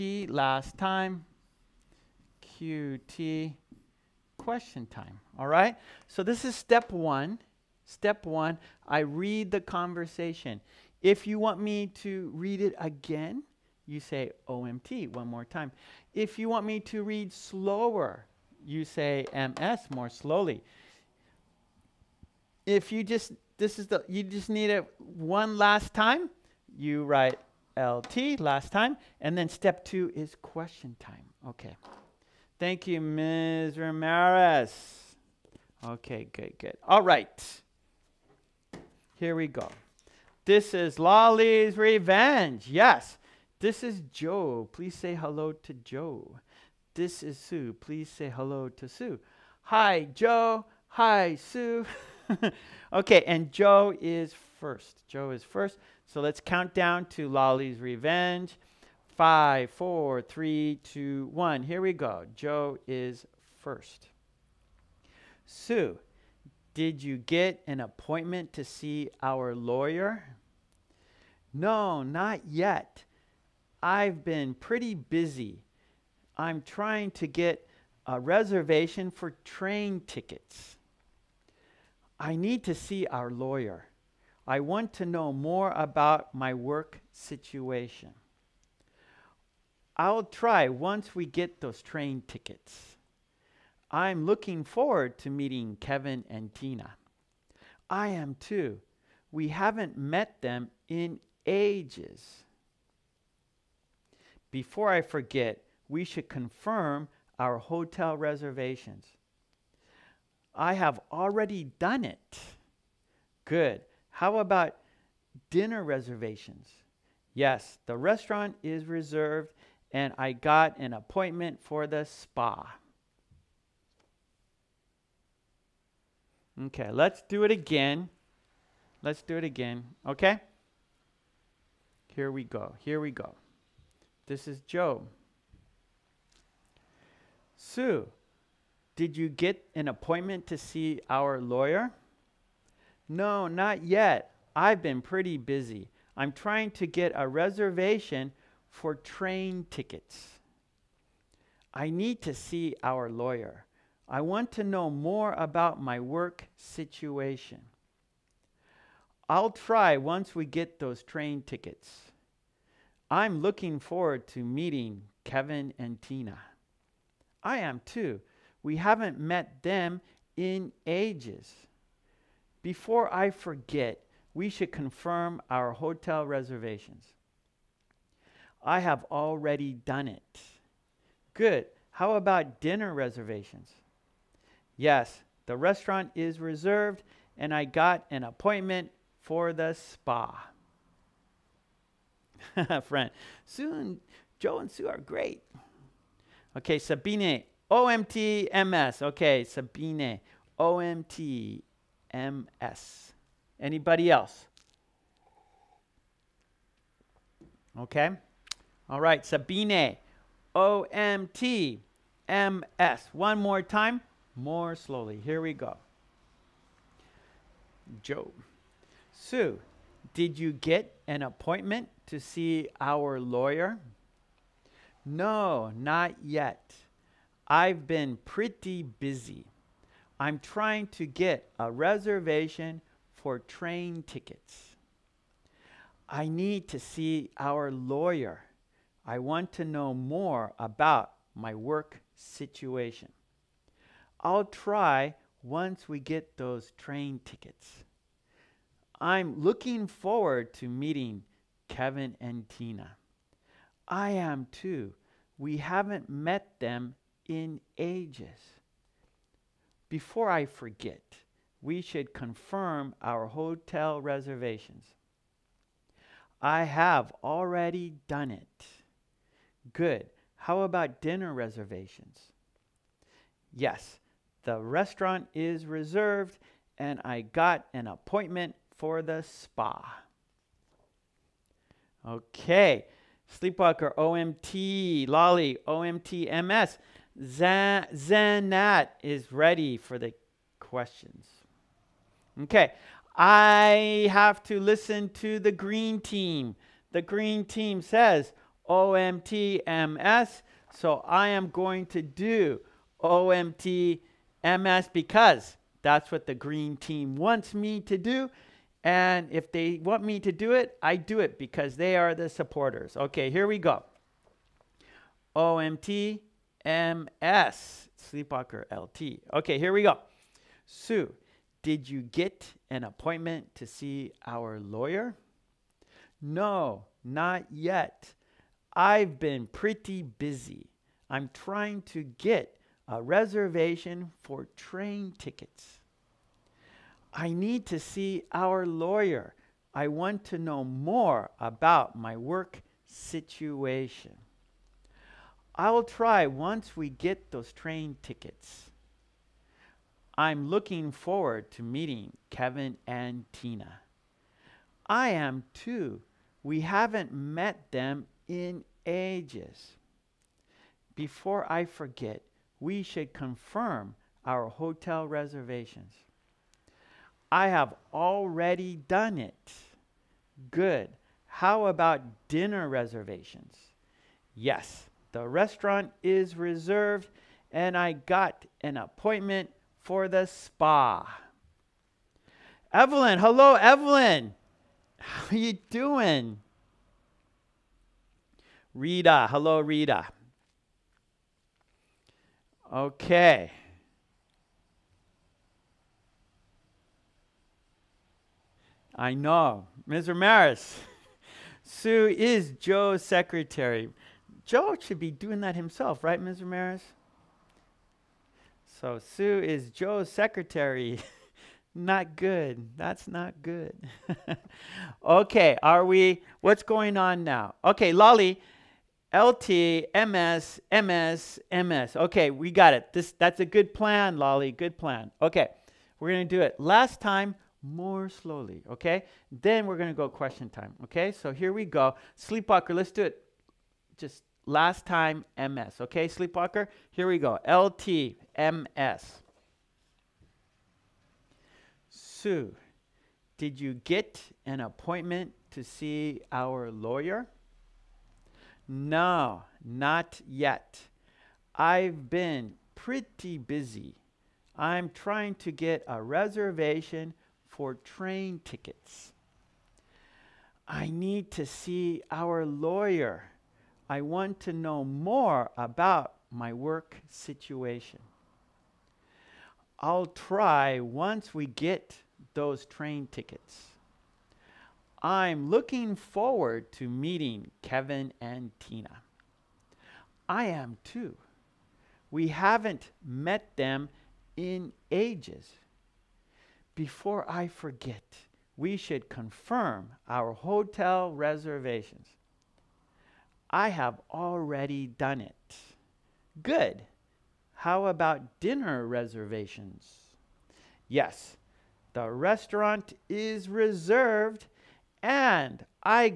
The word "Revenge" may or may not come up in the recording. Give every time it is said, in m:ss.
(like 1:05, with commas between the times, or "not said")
0:41, 0:57.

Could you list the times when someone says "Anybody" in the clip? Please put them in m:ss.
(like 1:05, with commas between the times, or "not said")
3:23.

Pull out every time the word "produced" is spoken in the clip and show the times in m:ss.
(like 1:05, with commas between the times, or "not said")
not said.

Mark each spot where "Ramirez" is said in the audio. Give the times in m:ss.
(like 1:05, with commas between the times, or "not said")
0:33, 6:40, 6:46.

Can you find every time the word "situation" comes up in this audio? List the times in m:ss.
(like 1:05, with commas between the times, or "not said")
1:27, 2:36, 4:02, 5:42, 7:47.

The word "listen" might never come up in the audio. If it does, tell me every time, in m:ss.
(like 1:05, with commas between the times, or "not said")
4:54.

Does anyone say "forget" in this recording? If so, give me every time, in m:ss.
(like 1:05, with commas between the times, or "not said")
1:45, 2:53, 4:20, 6:01, 8:07.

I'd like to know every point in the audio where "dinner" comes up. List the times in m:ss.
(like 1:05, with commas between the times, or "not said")
1:55, 3:02, 4:31, 6:12, 8:18.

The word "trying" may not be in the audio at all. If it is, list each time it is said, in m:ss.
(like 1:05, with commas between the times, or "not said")
1:16, 2:26, 3:50, 5:31, 7:34.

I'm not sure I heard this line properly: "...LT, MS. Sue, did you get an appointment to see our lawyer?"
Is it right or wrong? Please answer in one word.
right.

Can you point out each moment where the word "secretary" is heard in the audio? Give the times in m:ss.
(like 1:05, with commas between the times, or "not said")
6:43, 6:50.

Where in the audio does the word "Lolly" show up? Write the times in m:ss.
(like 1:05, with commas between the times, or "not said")
0:40, 0:57, 4:45, 6:57, 7:04.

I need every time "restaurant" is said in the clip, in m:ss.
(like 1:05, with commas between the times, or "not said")
1:57, 3:05, 4:34, 6:15, 8:22.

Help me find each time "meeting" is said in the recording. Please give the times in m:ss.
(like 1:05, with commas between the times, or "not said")
1:35, 2:44, 4:10, 5:51, 7:56.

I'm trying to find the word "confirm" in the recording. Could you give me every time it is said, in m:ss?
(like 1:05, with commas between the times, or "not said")
1:46, 2:54, 4:22, 6:03, 8:09.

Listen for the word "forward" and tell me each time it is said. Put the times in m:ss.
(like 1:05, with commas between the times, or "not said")
1:34, 2:43, 4:09, 5:50, 7:55.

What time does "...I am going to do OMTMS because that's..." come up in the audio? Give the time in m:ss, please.
5:01.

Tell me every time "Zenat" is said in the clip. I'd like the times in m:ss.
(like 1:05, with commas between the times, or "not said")
4:47.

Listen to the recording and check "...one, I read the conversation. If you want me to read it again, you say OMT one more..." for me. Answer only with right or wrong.
right.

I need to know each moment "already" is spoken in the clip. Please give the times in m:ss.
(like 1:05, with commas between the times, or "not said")
1:51, 2:59, 4:27, 6:07, 8:14.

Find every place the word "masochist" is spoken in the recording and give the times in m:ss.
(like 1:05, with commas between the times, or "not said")
not said.